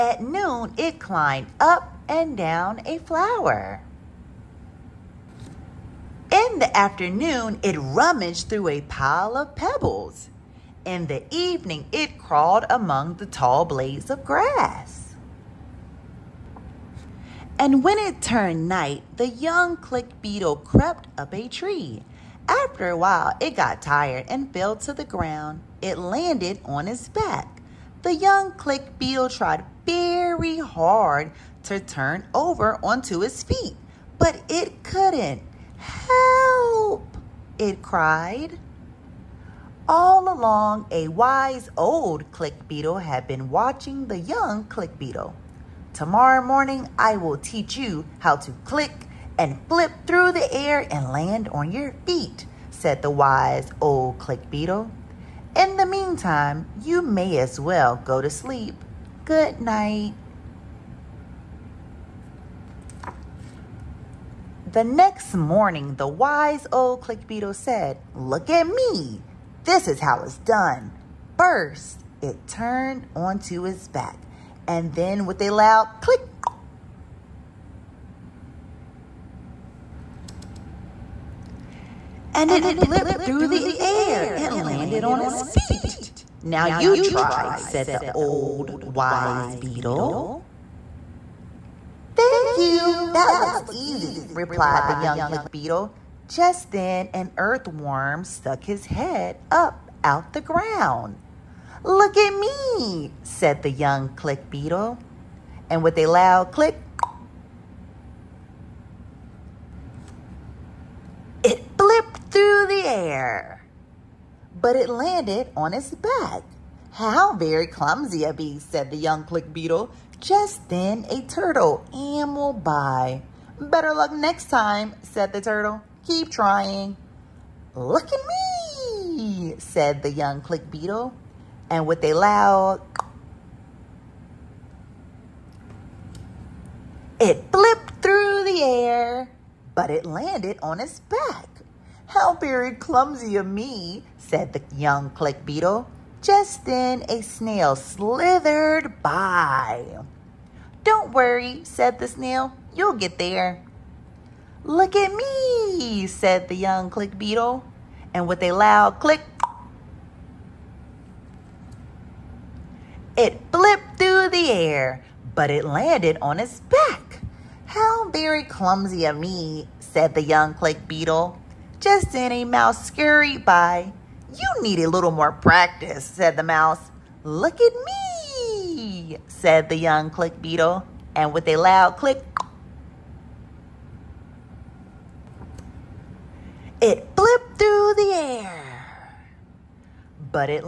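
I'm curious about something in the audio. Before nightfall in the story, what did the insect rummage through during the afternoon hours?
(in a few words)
A pile of pebbles.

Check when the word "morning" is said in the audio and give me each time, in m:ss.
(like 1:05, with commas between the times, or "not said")
0:46, 1:05.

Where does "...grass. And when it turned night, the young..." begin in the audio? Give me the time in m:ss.
0:14.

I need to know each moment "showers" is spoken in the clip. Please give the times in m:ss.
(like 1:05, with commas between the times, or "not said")
not said.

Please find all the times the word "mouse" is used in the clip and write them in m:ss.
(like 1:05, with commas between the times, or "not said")
2:52, 2:56.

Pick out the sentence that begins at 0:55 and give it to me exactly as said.
In the meantime, you may as well go to sleep.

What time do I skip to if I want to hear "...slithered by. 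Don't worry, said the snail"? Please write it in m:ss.
2:27.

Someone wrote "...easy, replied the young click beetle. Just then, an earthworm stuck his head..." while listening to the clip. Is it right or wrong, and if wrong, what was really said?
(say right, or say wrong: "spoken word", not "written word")
right.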